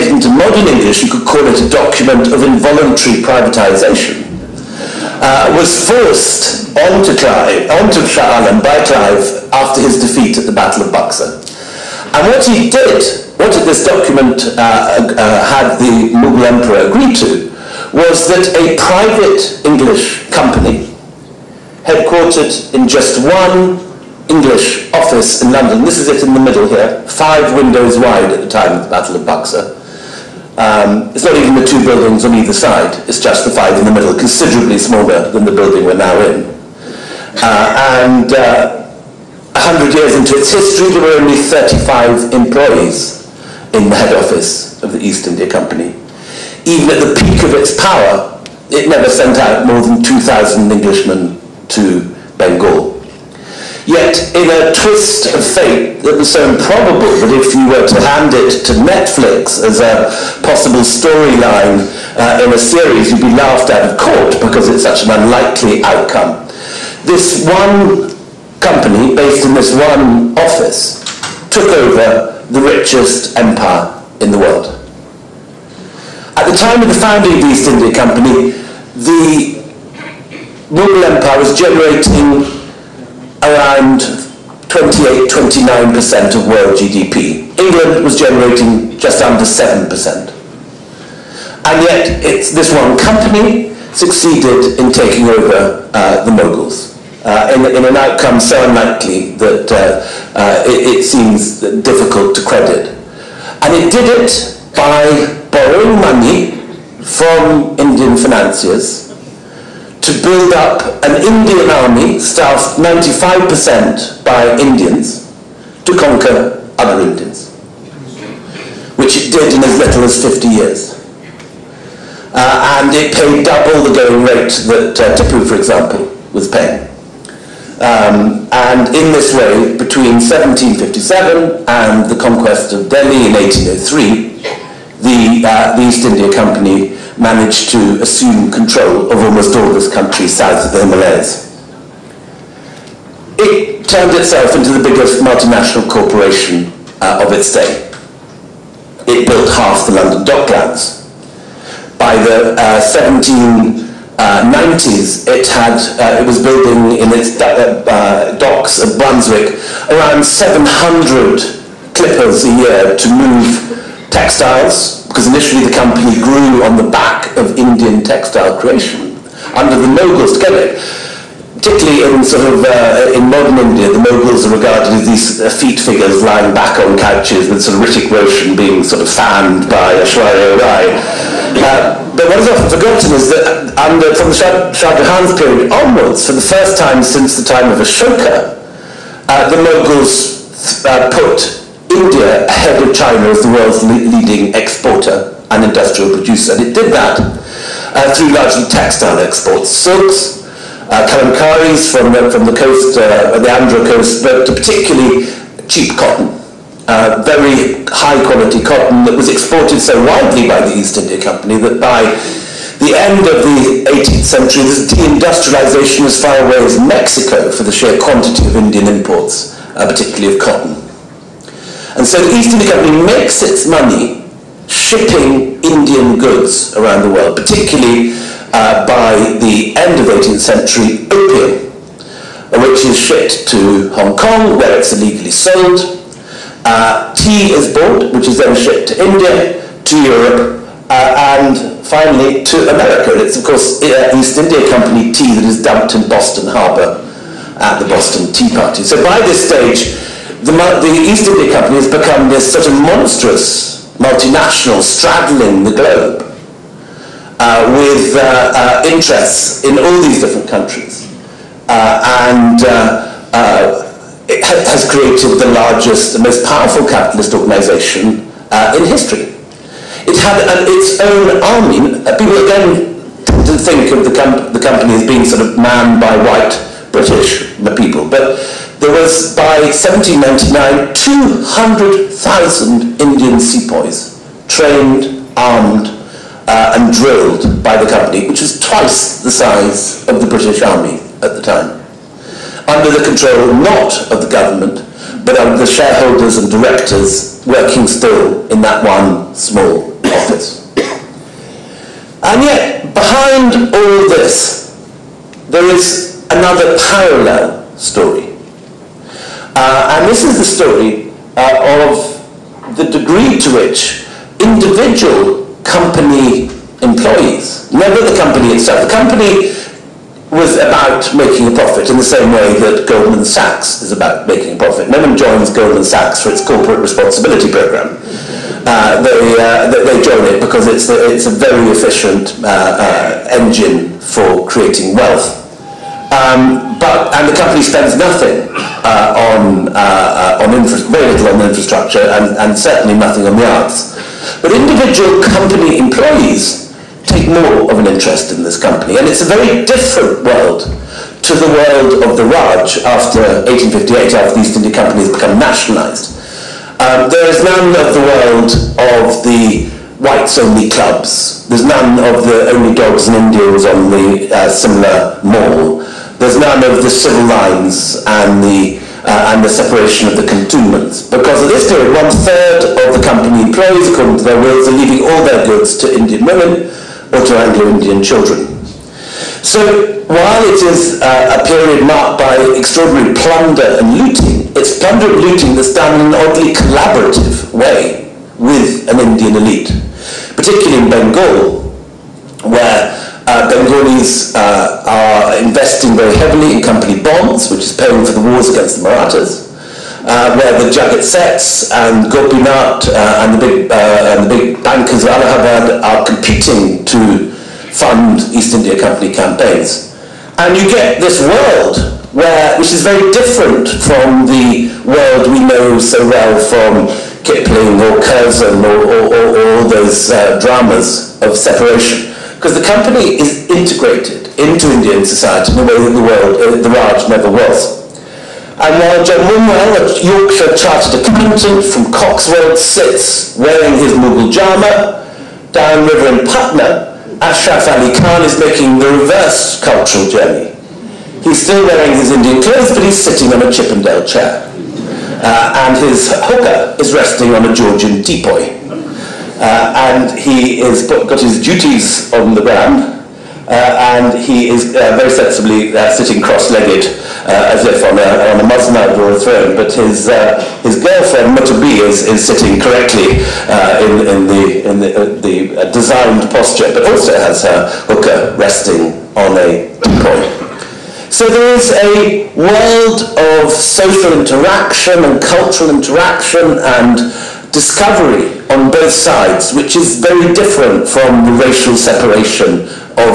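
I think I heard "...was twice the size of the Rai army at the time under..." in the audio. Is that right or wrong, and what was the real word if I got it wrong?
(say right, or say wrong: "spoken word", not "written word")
wrong: "British", not "Rai".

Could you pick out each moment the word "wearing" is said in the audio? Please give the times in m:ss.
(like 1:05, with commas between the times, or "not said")
7:13, 7:21.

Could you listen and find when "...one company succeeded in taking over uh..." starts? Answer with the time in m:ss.
1:32.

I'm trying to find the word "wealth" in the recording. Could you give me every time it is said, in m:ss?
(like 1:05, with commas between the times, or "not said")
5:34.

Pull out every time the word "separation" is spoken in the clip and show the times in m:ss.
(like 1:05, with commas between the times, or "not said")
6:09, 7:01, 8:01.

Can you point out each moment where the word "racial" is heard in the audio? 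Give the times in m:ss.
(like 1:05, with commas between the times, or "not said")
8:01.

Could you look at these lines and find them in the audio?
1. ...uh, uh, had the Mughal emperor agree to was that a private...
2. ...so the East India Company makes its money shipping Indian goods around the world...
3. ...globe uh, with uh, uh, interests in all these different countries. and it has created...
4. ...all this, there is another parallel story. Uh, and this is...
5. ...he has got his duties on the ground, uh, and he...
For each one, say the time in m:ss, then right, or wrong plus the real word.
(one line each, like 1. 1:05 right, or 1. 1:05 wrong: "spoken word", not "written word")
1. 0:14 right
2. 3:42 right
3. 4:15 right
4. 5:03 right
5. 7:30 right.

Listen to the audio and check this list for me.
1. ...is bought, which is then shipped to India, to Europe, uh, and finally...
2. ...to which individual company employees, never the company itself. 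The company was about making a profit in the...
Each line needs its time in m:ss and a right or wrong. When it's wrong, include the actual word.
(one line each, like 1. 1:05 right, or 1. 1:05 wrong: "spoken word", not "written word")
1. 3:57 right
2. 5:13 right.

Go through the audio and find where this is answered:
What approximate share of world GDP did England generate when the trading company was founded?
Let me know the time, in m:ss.
1:28.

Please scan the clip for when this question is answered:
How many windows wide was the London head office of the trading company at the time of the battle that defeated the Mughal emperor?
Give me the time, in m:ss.
0:27.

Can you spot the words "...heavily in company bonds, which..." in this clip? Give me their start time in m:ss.
6:36.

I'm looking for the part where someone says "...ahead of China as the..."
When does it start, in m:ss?
3:12.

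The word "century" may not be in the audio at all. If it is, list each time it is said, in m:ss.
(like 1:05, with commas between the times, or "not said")
3:34, 3:50.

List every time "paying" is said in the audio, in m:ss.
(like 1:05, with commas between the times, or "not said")
2:06, 6:37.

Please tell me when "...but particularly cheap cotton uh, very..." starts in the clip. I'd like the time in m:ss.
3:24.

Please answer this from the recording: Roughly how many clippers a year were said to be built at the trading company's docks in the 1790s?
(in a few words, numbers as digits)
700.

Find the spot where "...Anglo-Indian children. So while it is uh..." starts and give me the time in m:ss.
6:17.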